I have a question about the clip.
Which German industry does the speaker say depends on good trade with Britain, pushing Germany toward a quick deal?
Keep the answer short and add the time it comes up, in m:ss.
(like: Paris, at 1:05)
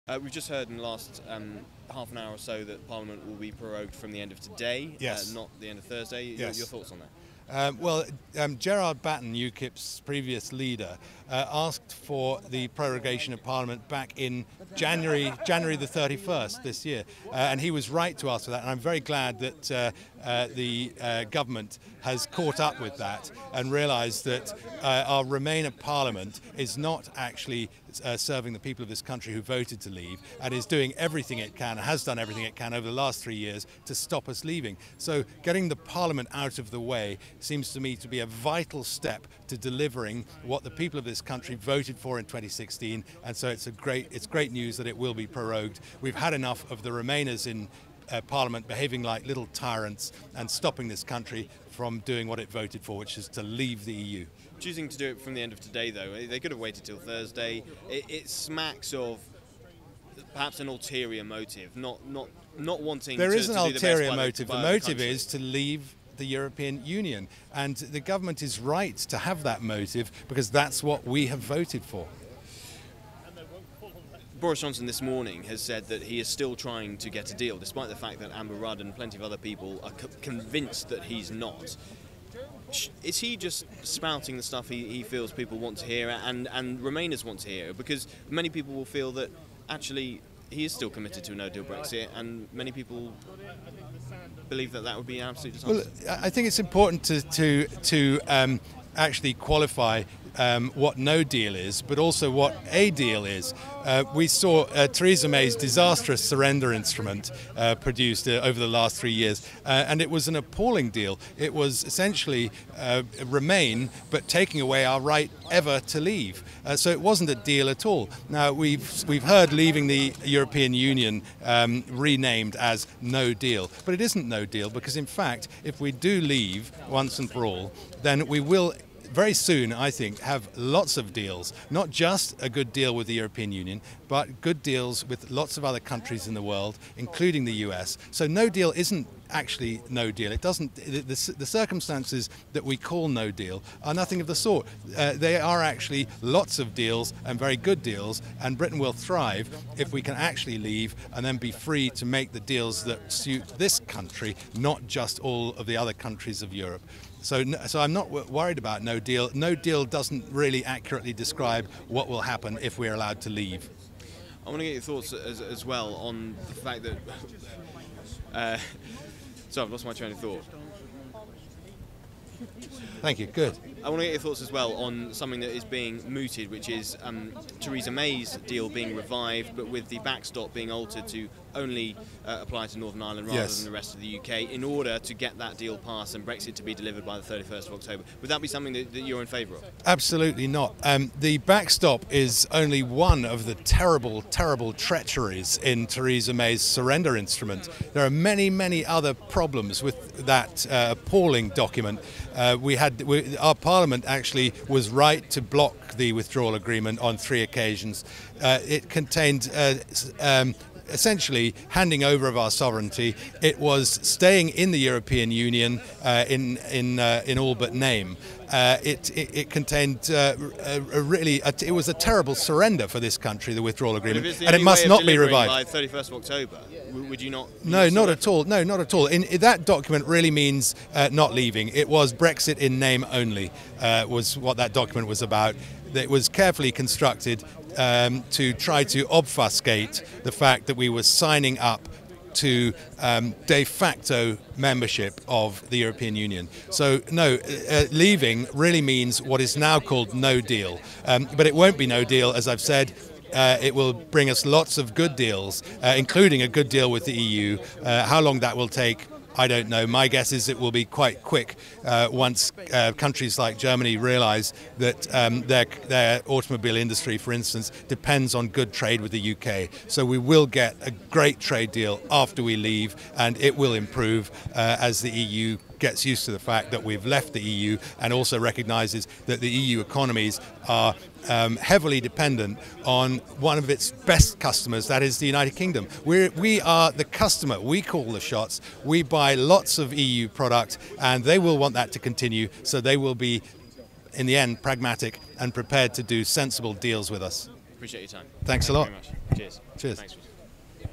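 automobile industry, at 4:26.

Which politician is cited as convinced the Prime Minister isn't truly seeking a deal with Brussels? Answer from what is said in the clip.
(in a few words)
Amber Rudd.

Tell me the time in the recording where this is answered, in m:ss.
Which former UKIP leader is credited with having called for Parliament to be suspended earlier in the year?
0:08.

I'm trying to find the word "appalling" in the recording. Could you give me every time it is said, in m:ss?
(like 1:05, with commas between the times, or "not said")
1:50, 3:20.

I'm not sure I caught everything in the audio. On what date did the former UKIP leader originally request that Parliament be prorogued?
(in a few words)
January 31st.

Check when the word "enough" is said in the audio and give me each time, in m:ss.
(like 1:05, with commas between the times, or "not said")
0:46.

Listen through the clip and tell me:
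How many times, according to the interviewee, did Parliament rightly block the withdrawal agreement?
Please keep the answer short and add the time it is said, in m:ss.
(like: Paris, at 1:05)
3, at 3:27.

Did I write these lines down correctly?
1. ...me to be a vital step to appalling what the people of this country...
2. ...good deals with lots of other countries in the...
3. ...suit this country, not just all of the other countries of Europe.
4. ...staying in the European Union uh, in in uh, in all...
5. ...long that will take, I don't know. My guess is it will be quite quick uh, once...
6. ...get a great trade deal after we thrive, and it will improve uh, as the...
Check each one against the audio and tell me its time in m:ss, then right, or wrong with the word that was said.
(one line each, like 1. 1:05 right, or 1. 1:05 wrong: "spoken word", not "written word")
1. 0:37 wrong: "delivering", not "appalling"
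2. 2:14 right
3. 2:33 right
4. 3:34 right
5. 4:18 right
6. 4:30 wrong: "leave", not "thrive".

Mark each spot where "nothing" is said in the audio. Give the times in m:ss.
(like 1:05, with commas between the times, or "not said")
2:23.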